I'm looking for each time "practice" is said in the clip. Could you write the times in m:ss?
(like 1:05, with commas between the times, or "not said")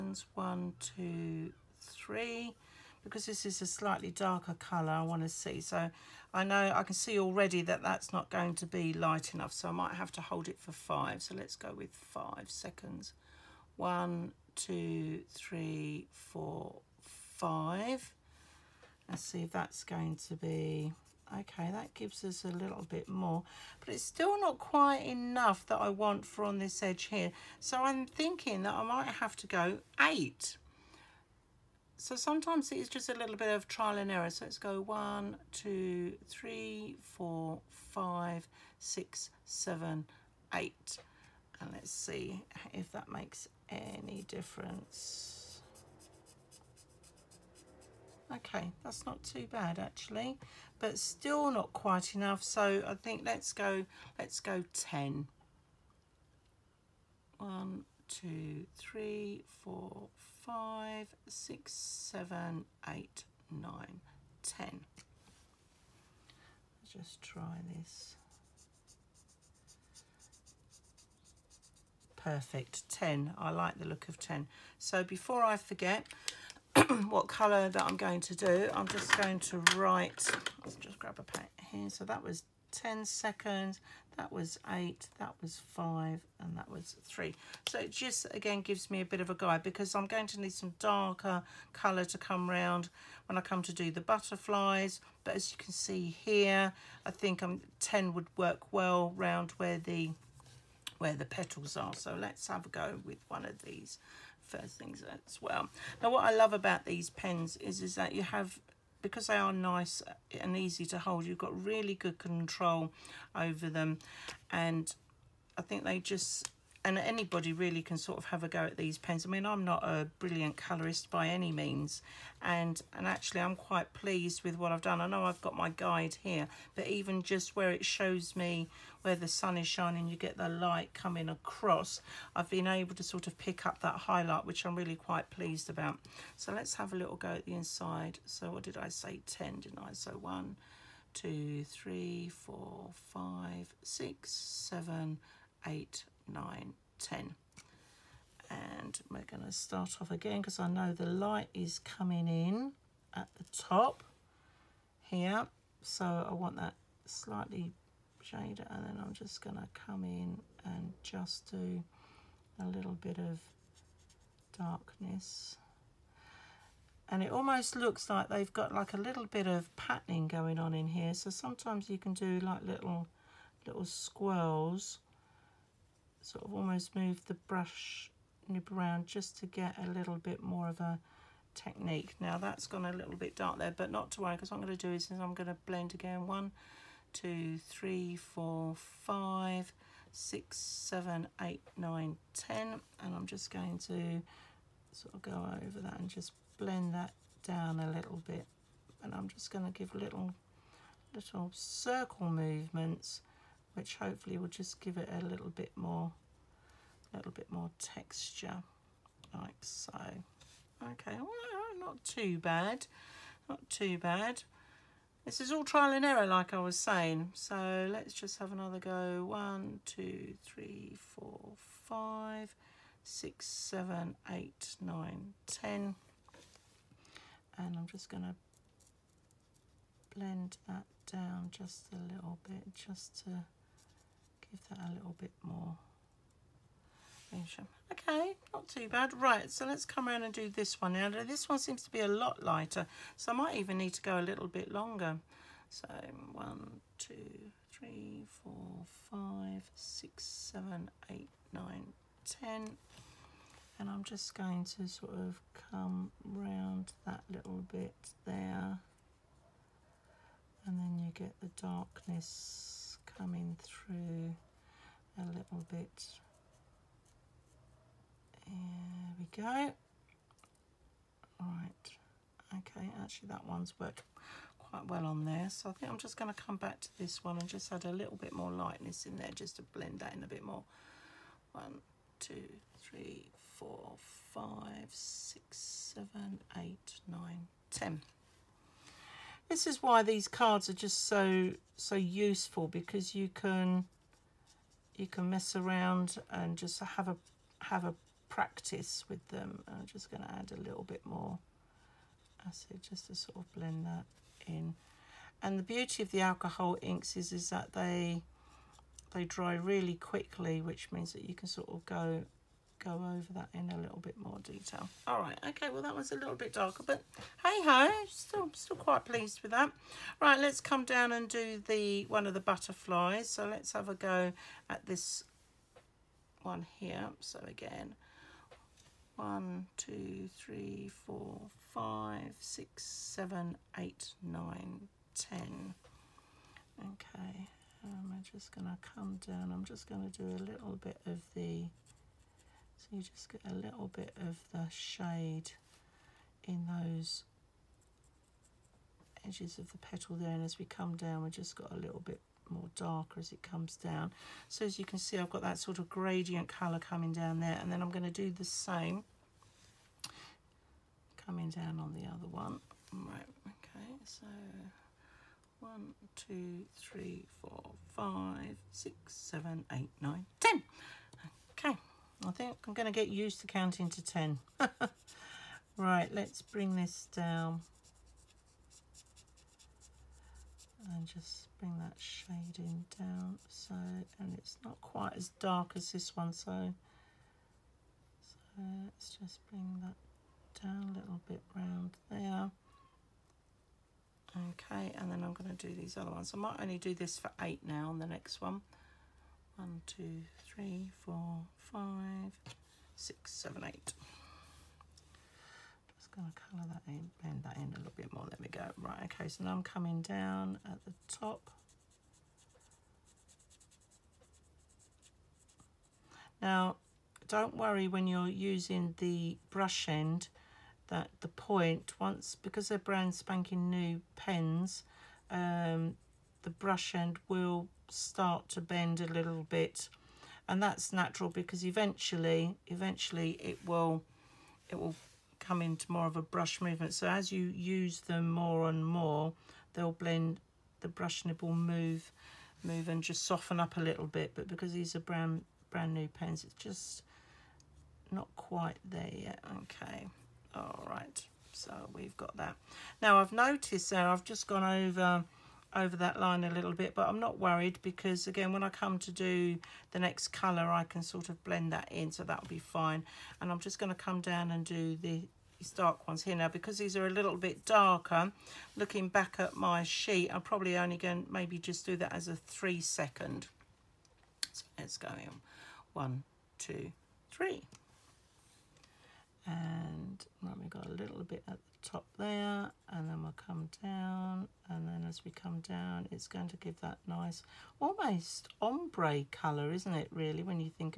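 4:58.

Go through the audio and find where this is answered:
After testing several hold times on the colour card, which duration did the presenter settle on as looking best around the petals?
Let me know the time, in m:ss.
1:12.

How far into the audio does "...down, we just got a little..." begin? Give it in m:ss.
5:50.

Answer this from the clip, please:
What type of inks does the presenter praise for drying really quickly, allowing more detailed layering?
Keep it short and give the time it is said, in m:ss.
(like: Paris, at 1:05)
alcohol inks, at 5:06.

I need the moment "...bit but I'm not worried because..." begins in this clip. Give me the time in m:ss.
7:36.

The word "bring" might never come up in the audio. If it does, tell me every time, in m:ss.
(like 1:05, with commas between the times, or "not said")
6:16, 6:21, 6:29.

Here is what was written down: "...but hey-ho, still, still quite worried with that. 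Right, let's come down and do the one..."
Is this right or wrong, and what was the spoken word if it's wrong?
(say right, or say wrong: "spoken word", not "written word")
wrong: "pleased", not "worried".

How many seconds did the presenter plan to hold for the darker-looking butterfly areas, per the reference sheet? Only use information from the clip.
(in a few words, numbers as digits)
3.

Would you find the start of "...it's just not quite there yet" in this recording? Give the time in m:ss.
7:26.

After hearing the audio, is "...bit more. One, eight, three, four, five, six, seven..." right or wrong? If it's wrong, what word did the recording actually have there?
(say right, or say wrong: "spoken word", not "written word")
wrong: "two", not "eight".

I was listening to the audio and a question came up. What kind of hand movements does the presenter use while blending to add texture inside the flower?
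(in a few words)
little circle movements.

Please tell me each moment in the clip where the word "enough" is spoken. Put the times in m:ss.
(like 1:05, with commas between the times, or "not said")
0:09, 0:25, 0:52.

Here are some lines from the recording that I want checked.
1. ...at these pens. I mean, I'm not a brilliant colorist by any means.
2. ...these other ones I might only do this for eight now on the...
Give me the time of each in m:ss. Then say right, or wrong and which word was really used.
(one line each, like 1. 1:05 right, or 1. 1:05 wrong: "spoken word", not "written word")
1. 1:58 right
2. 6:35 right.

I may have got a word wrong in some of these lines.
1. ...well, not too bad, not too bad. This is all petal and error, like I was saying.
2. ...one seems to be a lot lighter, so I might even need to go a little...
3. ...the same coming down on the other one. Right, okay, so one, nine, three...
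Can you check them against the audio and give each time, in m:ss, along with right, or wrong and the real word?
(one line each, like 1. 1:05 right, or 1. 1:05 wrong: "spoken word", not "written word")
1. 3:31 wrong: "trial", not "petal"
2. 4:01 right
3. 5:58 wrong: "two", not "nine".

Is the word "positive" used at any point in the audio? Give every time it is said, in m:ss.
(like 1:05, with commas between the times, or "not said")
not said.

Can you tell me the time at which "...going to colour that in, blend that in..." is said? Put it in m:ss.
6:46.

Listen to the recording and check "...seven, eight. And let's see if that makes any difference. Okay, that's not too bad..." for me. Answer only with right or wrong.
right.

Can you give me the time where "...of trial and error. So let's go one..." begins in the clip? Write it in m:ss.
0:33.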